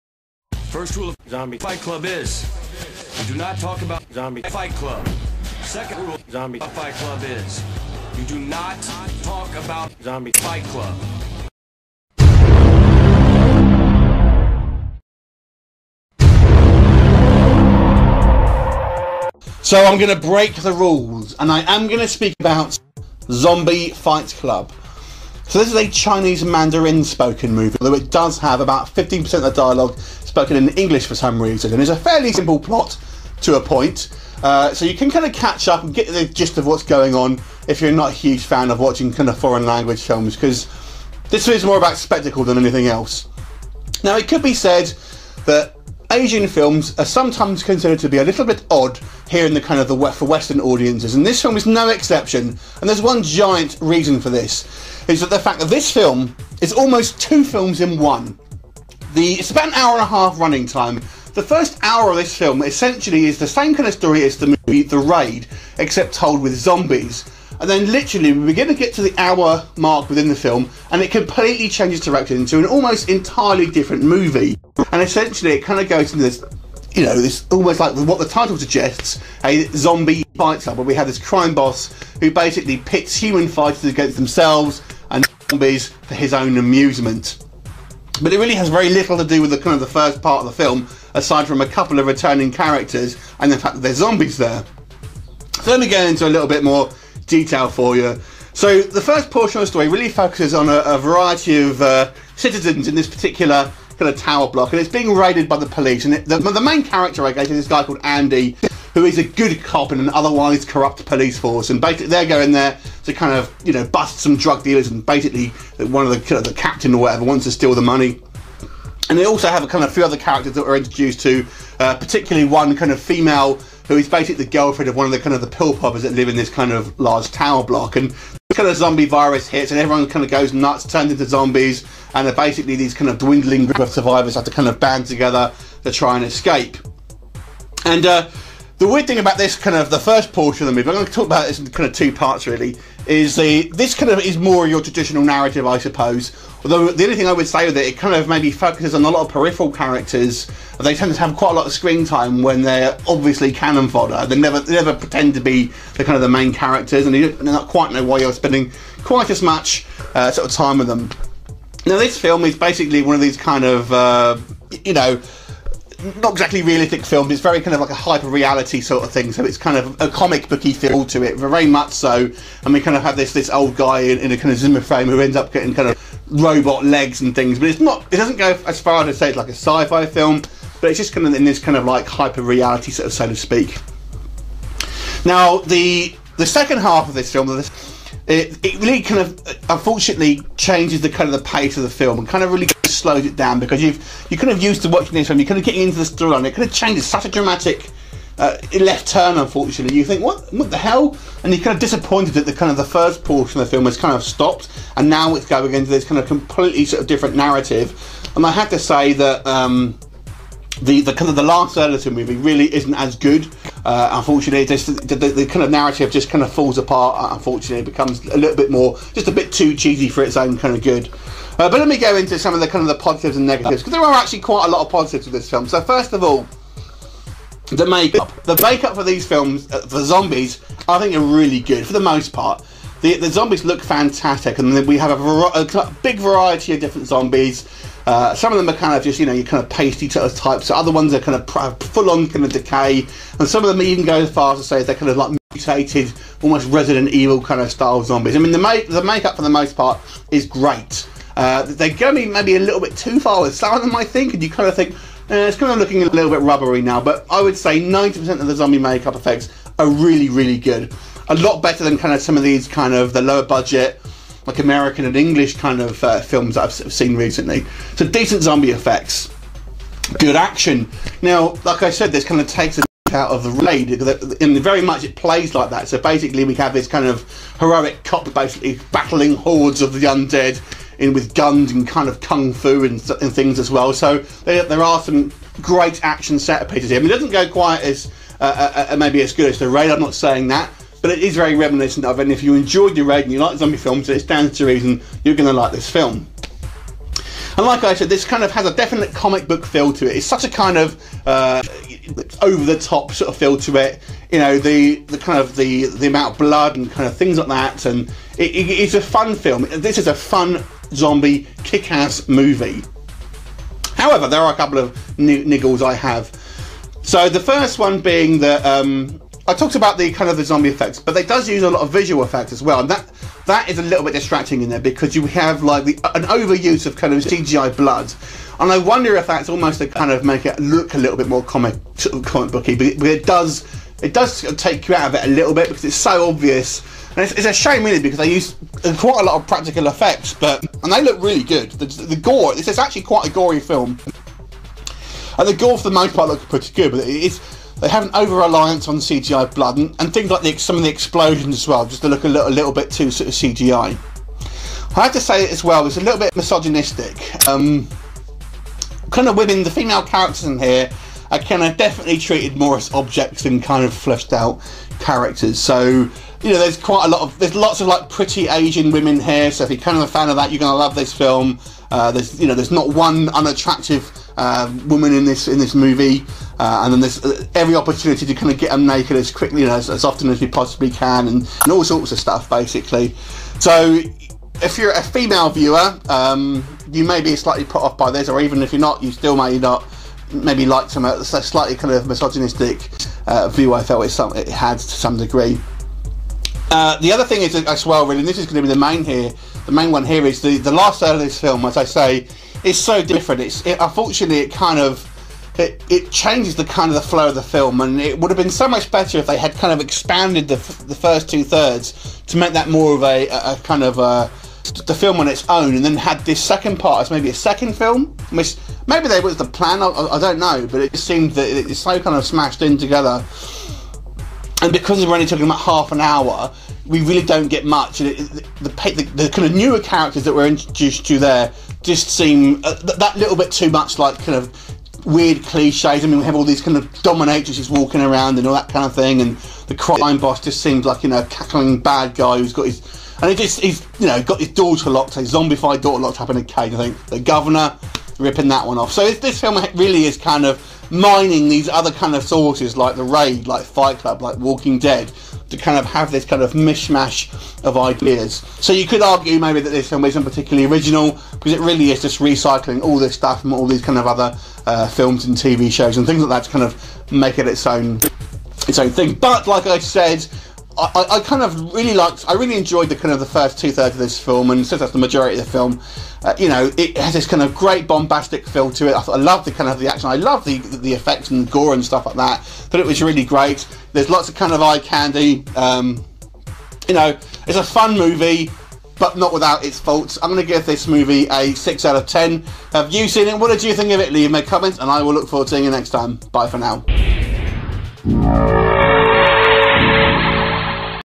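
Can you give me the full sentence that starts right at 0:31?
And it's a fairly simple plot to a point.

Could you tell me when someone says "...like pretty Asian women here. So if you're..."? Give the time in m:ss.
6:07.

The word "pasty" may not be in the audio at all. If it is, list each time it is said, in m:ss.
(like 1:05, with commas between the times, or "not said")
3:59.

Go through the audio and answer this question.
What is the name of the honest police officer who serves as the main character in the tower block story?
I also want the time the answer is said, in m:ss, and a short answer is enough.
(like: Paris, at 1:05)
Andy, at 1:48.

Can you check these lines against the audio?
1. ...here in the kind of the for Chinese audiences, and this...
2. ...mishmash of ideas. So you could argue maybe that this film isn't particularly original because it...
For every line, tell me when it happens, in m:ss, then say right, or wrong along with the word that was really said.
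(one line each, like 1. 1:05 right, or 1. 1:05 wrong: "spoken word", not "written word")
1. 0:49 wrong: "Western", not "Chinese"
2. 7:36 right.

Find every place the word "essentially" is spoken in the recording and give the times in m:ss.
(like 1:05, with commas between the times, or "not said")
1:02, 1:15.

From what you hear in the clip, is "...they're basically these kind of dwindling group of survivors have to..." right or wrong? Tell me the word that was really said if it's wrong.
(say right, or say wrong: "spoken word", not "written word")
right.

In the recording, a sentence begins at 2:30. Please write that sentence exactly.
They tend to have quite a lot of screen time when they're obviously cannon fodder.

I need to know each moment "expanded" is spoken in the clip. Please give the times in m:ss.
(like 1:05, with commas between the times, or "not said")
6:49.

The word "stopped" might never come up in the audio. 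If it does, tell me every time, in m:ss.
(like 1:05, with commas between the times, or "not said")
3:24.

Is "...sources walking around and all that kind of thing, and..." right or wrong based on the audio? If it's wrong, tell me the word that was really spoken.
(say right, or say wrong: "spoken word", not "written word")
wrong: "dominatrixes", not "sources".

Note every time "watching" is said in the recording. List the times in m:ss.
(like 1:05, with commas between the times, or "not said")
0:38, 3:14.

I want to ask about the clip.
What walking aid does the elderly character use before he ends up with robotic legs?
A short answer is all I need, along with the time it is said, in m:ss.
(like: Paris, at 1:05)
Zimmer frame, at 2:54.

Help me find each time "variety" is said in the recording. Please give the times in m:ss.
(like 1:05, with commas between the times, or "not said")
1:40, 3:56.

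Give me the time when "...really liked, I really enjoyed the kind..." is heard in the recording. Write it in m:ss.
7:51.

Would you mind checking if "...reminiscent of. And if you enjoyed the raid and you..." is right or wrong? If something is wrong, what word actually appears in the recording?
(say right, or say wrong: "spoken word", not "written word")
right.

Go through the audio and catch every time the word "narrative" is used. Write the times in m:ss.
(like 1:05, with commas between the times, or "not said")
2:25, 3:27, 3:35.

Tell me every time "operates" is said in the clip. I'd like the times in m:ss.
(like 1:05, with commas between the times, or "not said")
not said.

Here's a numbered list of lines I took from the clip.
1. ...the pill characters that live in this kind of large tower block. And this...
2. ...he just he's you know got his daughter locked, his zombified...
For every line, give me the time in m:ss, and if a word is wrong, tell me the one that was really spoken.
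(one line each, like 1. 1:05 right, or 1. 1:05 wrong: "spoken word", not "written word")
1. 2:05 wrong: "poppers", not "characters"
2. 7:23 right.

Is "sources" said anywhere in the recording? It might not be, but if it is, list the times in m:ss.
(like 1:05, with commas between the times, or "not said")
7:32.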